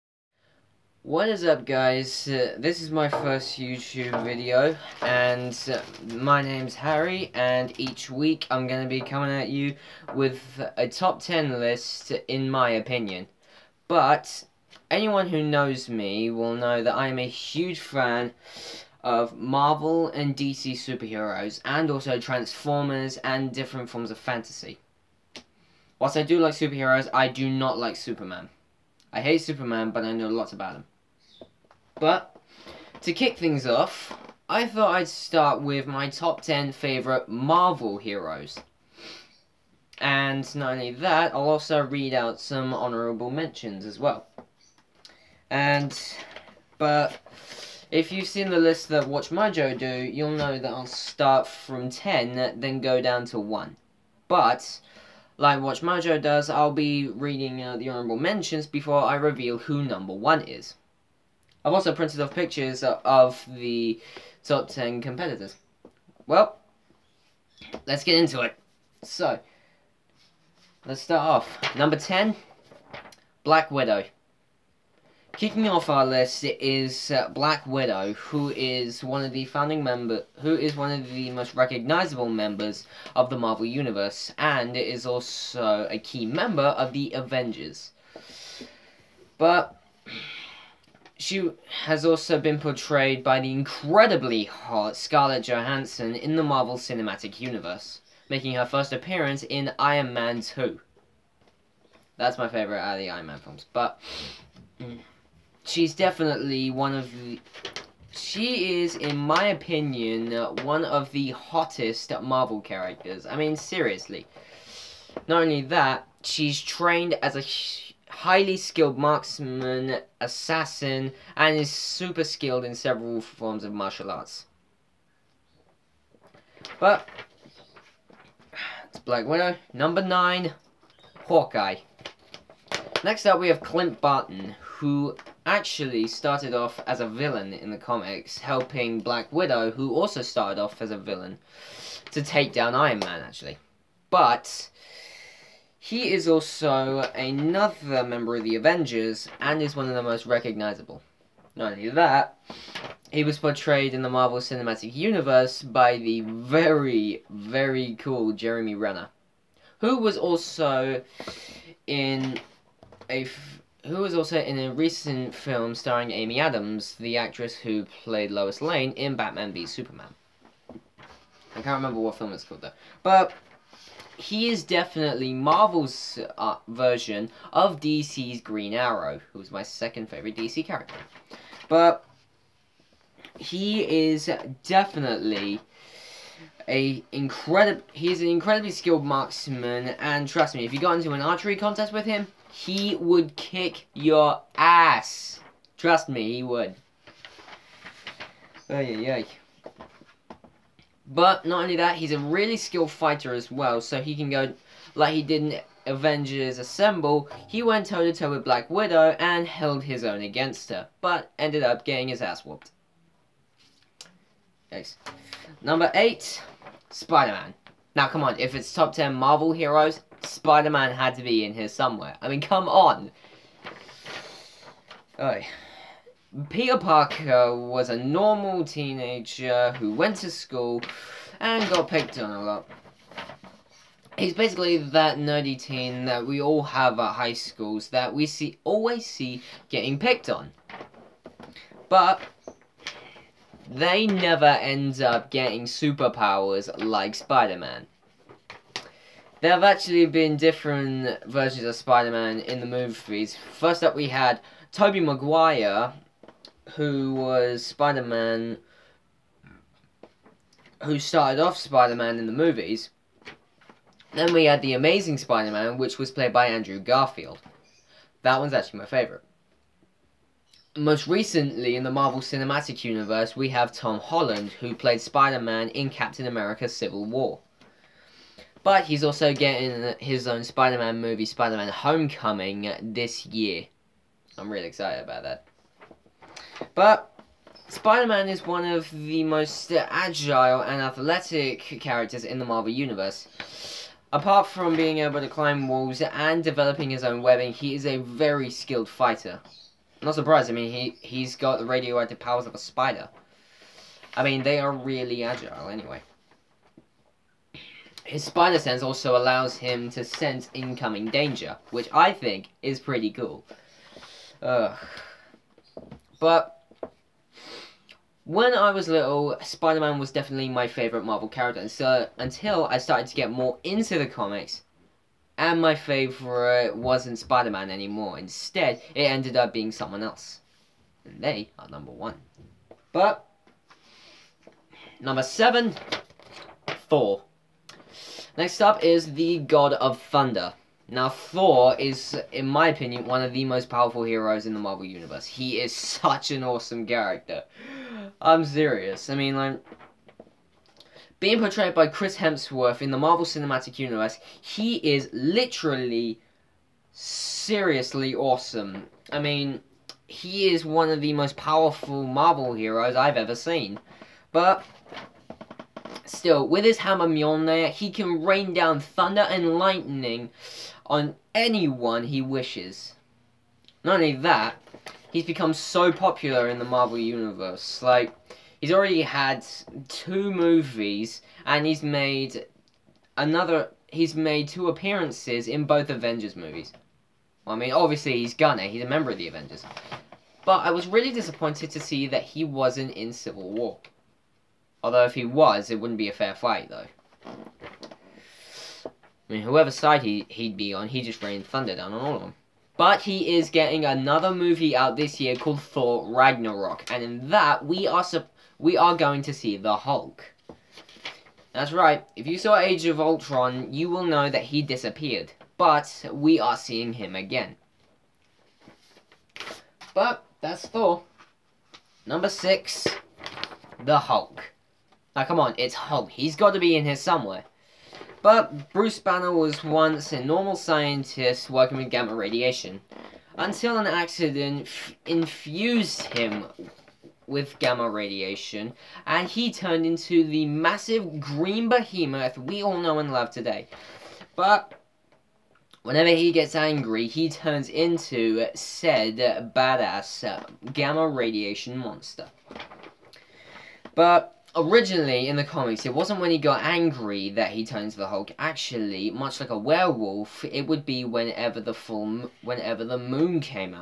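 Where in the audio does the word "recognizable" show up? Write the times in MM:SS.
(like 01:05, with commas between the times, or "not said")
01:21, 02:30.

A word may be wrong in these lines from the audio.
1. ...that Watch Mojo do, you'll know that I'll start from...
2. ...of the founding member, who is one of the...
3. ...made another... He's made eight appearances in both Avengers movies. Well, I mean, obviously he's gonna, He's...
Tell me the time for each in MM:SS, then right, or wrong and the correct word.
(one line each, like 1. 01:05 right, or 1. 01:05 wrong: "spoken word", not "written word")
1. 00:48 right
2. 01:19 right
3. 06:21 wrong: "two", not "eight".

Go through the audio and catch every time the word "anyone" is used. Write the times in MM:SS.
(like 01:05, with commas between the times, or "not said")
00:14, 06:11.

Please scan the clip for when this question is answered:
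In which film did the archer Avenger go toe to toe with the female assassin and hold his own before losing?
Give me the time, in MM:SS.
03:25.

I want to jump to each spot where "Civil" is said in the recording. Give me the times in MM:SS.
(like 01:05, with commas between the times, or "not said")
04:36, 06:33.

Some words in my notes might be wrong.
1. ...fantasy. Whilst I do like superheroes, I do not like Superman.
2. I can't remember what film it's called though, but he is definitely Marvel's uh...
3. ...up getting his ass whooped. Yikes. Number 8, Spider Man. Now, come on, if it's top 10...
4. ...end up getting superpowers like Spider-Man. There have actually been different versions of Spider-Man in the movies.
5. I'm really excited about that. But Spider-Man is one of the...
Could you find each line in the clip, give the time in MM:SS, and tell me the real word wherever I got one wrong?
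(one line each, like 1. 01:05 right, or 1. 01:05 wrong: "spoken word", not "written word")
1. 00:24 right
2. 02:50 right
3. 03:31 right
4. 04:04 right
5. 04:44 right.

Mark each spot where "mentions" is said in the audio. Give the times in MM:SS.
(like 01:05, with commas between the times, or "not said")
00:43, 00:58.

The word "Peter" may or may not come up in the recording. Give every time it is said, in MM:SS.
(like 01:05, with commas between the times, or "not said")
03:46.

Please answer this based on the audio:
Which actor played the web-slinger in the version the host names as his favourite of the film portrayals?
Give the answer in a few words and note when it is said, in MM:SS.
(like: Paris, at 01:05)
Andrew Garfield, at 04:26.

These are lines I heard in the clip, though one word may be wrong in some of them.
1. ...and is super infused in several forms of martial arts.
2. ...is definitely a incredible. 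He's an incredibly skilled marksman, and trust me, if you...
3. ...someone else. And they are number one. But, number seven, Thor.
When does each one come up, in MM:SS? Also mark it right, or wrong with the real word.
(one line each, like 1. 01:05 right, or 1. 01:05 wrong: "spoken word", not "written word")
1. 02:01 wrong: "skilled", not "infused"
2. 03:04 right
3. 05:29 right.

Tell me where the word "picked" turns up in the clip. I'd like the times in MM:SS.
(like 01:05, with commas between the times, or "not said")
03:51, 03:59.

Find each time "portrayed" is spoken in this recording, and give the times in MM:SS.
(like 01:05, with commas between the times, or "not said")
01:32, 02:33, 05:51.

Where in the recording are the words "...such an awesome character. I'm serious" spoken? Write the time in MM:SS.
05:45.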